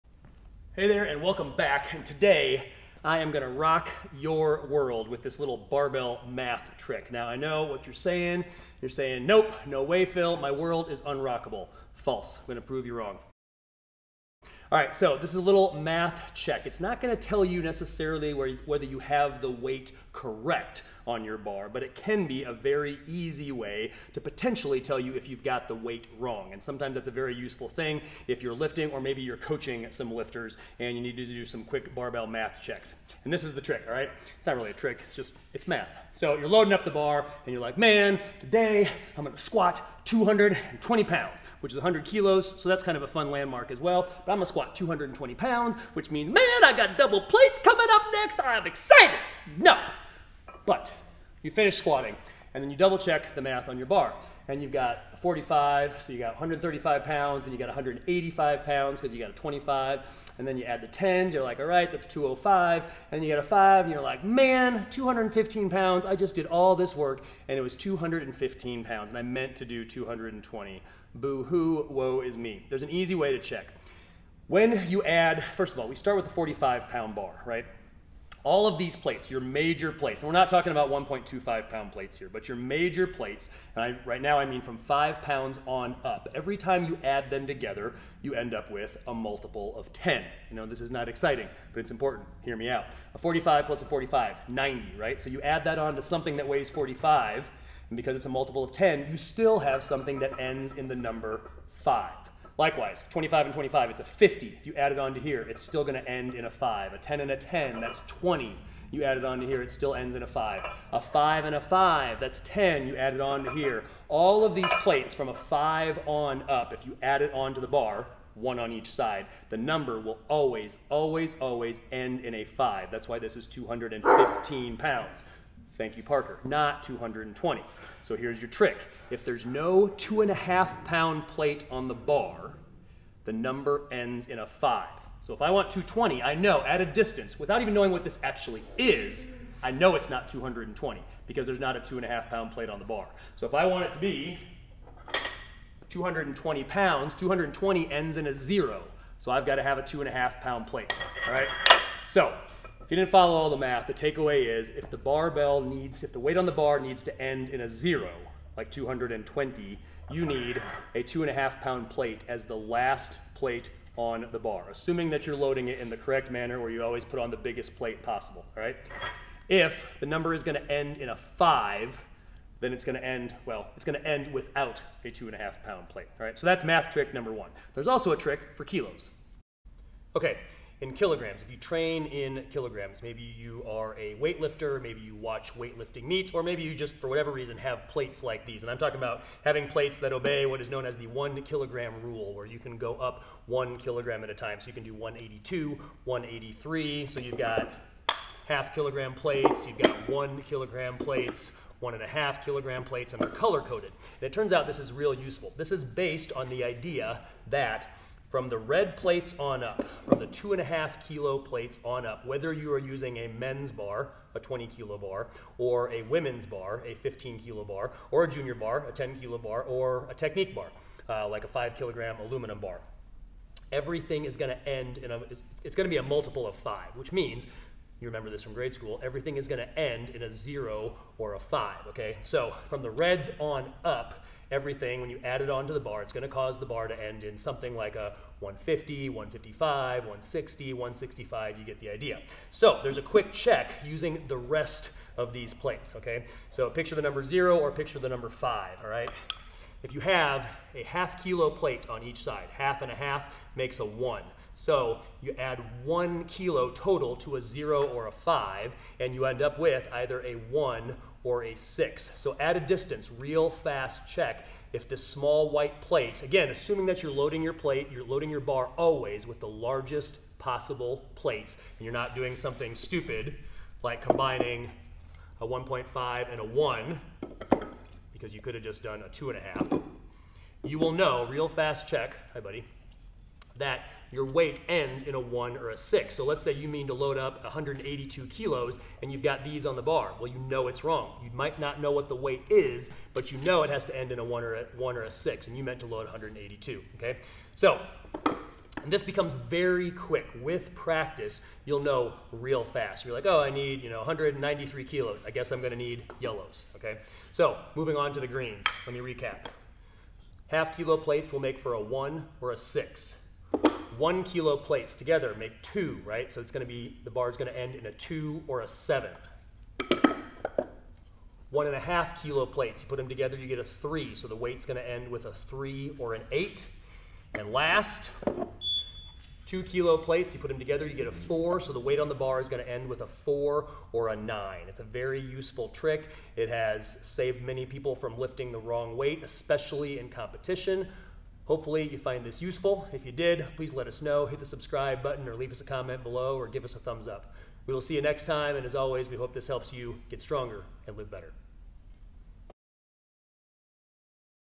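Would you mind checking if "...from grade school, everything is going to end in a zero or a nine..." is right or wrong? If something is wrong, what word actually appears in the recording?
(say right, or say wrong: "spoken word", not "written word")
wrong: "five", not "nine".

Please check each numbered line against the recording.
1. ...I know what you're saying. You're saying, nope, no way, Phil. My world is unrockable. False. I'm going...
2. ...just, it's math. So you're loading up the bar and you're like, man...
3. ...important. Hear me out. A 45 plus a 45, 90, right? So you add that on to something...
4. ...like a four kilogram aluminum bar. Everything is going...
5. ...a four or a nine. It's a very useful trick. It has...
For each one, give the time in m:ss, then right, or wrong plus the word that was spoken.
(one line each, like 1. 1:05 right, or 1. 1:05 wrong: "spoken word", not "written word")
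1. 0:07 right
2. 0:35 right
3. 1:31 right
4. 3:41 wrong: "five", not "four"
5. 5:33 right.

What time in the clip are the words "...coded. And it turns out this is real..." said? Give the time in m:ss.
3:23.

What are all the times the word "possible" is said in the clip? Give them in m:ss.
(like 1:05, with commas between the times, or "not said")
2:48, 4:30.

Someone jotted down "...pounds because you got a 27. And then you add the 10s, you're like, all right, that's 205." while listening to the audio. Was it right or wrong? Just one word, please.
wrong.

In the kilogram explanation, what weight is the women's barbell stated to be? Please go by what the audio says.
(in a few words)
15 kilos.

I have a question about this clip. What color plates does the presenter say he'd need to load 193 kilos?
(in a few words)
yellows.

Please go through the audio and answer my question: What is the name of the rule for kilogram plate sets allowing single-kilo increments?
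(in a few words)
one kilogram rule.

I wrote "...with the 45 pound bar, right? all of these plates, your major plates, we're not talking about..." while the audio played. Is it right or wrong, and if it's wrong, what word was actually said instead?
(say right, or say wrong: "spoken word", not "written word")
right.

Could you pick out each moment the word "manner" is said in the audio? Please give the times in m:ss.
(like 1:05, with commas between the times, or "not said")
2:46.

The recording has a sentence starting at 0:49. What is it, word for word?
No, but you finish squatting, and then you double check the math on your bar.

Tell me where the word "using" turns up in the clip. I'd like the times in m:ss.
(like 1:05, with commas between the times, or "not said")
3:32, 4:03.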